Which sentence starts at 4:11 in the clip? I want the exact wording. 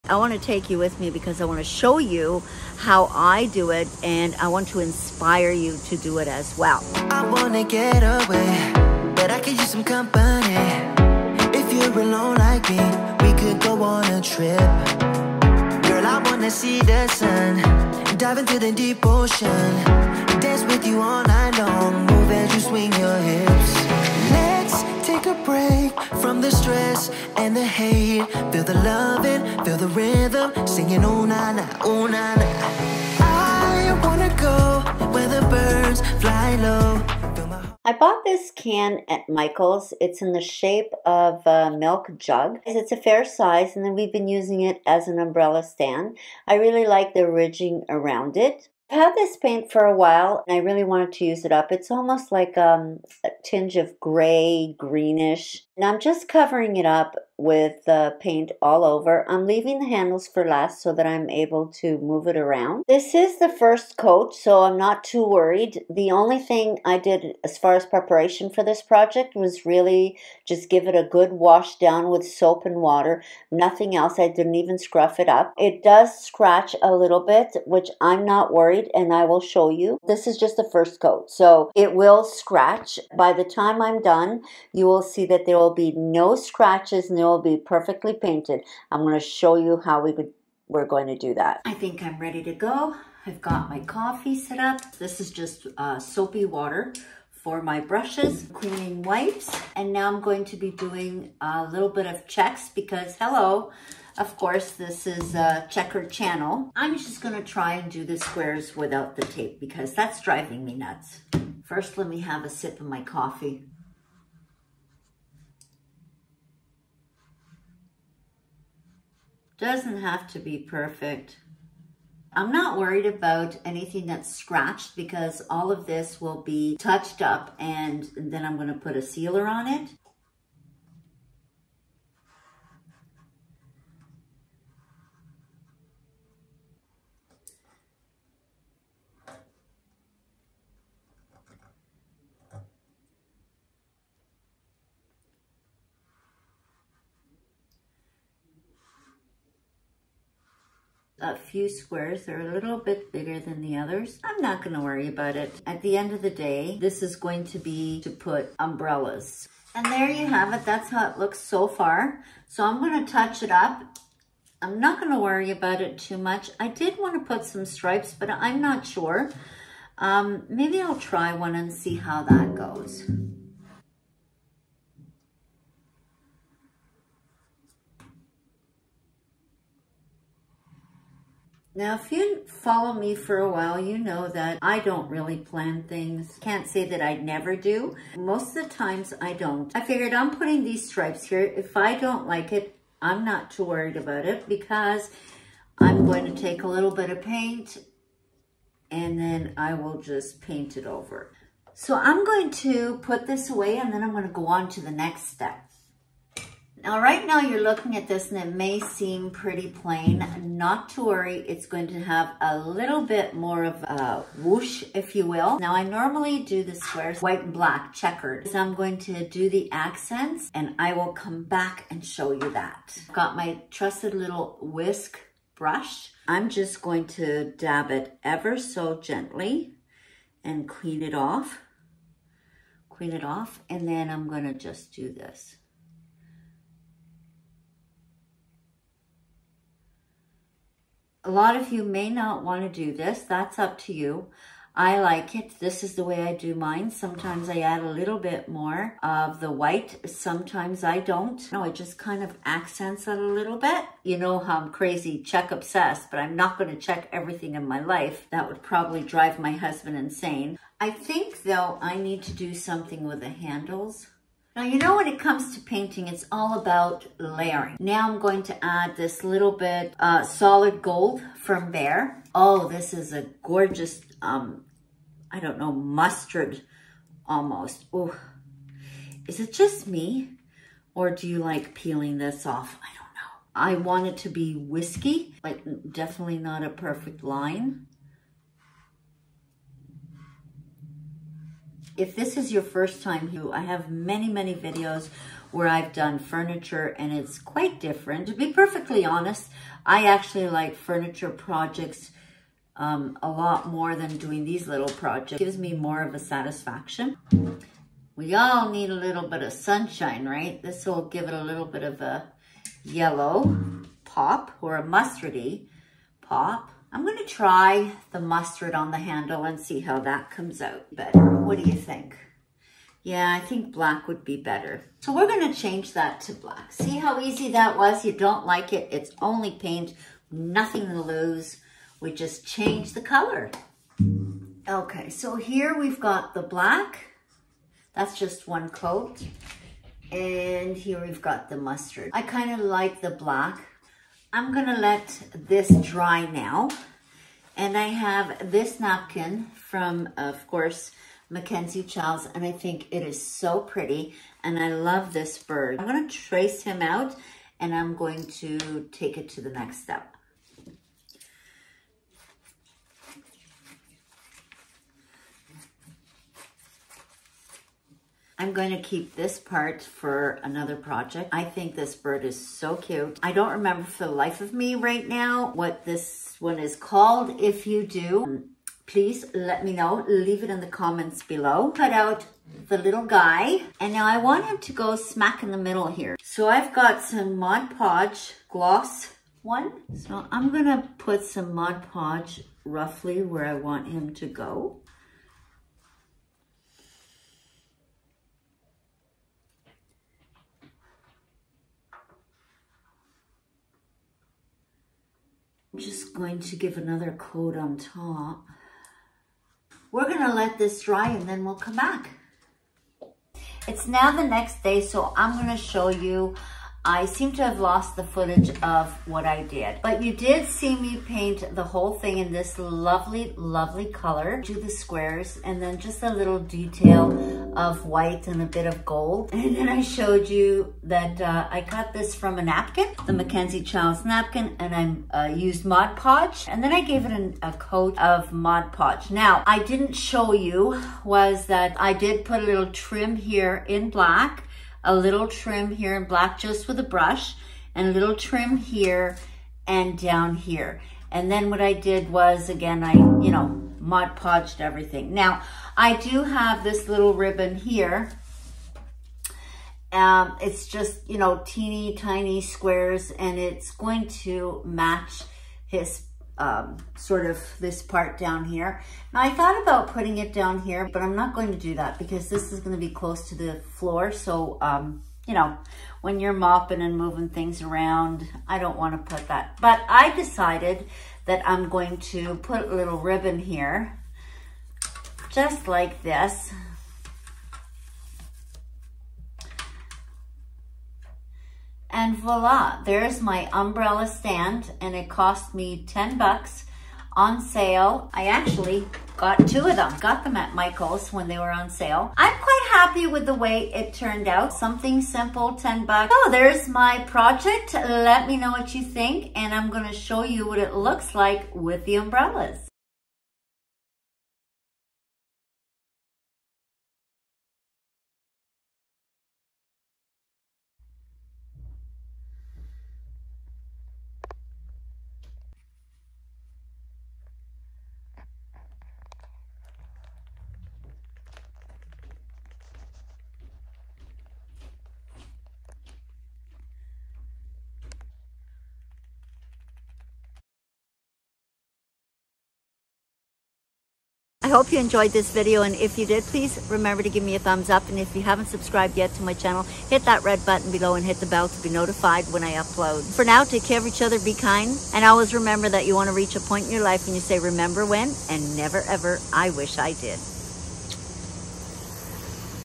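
No, I just kind of accents it a little bit.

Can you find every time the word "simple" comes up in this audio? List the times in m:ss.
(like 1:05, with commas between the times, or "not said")
8:25.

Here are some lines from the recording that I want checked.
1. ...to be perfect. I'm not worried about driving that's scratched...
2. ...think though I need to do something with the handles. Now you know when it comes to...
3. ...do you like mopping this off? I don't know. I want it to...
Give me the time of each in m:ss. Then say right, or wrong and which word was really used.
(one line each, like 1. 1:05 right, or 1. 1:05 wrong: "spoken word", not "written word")
1. 2:00 wrong: "anything", not "driving"
2. 4:20 right
3. 4:41 wrong: "peeling", not "mopping".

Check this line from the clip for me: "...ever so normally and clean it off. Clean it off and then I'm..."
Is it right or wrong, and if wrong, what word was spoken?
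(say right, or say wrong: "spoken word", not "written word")
wrong: "gently", not "normally".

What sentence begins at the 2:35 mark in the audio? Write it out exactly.
At the end of the day, this is going to be to put umbrellas.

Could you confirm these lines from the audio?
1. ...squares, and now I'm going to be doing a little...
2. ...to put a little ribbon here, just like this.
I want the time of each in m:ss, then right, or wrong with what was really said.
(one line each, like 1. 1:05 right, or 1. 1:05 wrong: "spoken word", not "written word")
1. 1:39 wrong: "wipes", not "squares"
2. 8:01 right.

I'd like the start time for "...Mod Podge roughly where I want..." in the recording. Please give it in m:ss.
6:31.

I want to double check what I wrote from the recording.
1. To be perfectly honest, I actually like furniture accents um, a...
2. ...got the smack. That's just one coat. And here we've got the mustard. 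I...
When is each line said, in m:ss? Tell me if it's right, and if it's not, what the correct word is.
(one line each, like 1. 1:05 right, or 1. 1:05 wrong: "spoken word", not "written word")
1. 4:58 wrong: "projects", not "accents"
2. 5:35 wrong: "black", not "smack".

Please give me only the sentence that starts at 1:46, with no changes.
I'm just gonna try and do the squares without the tape because that's driving me nuts.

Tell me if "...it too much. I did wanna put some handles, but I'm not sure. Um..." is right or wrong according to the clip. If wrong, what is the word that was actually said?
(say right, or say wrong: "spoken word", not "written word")
wrong: "stripes", not "handles".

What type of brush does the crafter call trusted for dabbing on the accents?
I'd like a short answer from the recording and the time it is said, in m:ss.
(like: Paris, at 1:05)
whisk brush, at 3:44.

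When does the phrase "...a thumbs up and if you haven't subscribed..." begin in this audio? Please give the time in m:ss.
9:07.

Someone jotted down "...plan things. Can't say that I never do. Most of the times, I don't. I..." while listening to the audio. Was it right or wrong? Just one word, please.
right.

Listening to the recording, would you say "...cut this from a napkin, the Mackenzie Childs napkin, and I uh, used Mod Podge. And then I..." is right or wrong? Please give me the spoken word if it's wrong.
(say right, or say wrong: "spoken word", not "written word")
right.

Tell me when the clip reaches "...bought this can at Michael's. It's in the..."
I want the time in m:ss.
0:37.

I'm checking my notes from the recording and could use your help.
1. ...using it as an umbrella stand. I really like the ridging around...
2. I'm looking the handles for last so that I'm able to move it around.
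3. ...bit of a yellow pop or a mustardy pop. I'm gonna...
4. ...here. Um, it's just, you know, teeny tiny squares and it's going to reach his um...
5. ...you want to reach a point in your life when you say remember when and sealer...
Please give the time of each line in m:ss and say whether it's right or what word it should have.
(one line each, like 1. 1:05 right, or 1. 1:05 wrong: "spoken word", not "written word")
1. 0:44 right
2. 0:59 wrong: "leaving", not "looking"
3. 5:11 right
4. 7:37 wrong: "match", not "reach"
5. 9:15 wrong: "never", not "sealer".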